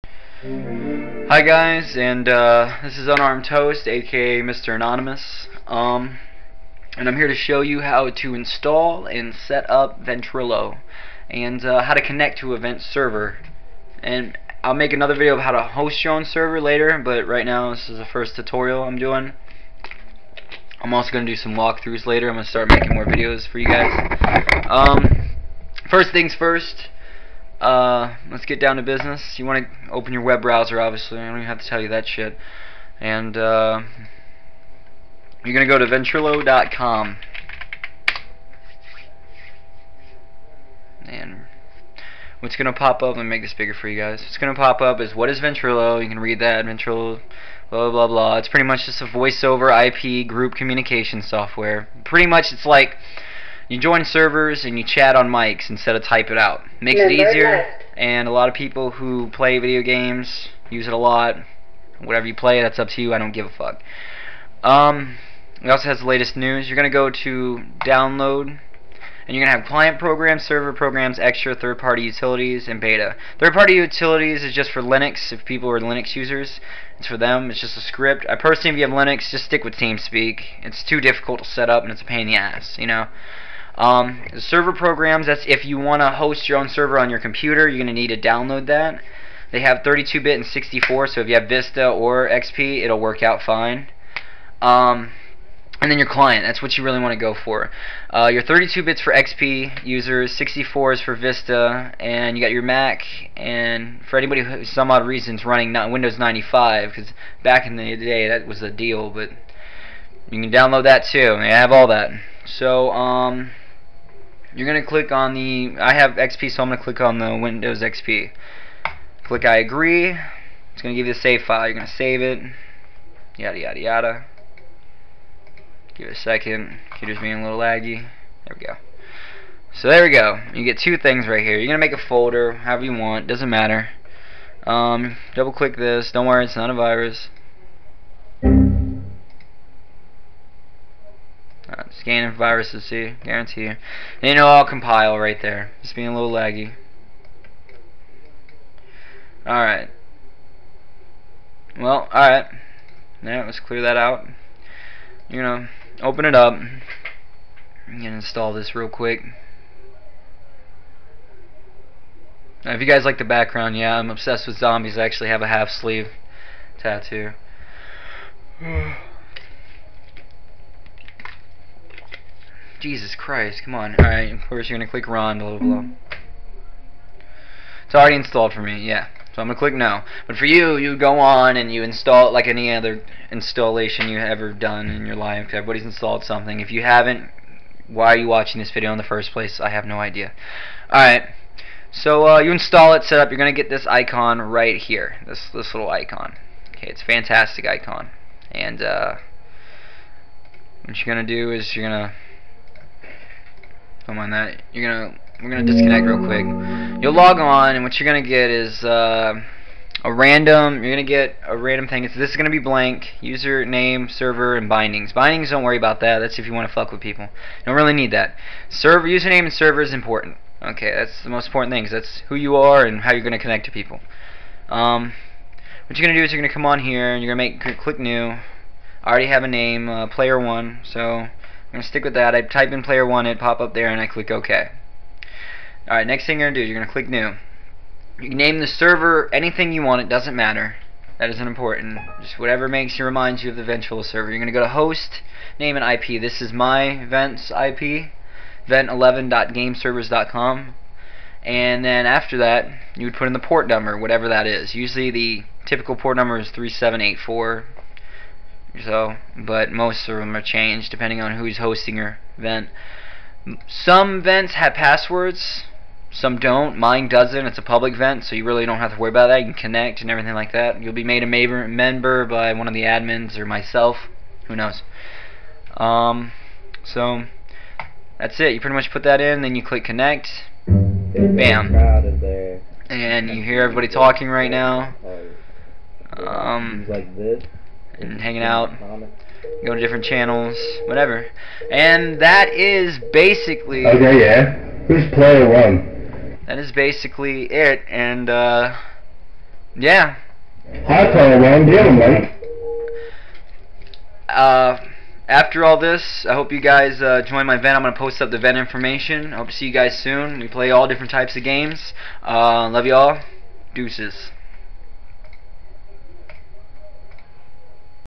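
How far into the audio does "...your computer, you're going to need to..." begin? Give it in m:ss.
1:27.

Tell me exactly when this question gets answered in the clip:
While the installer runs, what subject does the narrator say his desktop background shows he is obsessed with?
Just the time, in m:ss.
2:44.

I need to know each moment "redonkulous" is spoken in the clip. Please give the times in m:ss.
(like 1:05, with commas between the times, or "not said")
not said.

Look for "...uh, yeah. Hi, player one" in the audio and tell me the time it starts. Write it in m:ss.
4:58.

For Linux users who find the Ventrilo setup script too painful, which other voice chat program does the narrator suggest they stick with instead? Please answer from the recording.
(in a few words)
TeamSpeak.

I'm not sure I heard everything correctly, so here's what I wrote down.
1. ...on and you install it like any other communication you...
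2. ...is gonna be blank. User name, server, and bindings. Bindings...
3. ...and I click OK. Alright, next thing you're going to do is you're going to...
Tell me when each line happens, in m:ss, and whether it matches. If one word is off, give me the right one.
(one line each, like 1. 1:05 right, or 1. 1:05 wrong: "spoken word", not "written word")
1. 3:01 wrong: "installation", not "communication"
2. 3:32 right
3. 3:53 right.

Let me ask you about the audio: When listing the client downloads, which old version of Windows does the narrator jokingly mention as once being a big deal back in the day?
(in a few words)
Windows 95.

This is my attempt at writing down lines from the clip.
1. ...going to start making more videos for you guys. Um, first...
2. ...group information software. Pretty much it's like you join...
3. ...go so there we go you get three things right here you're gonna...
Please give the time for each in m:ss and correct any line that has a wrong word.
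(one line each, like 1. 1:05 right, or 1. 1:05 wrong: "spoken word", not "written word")
1. 0:22 right
2. 0:50 wrong: "communication", not "information"
3. 2:08 wrong: "two", not "three".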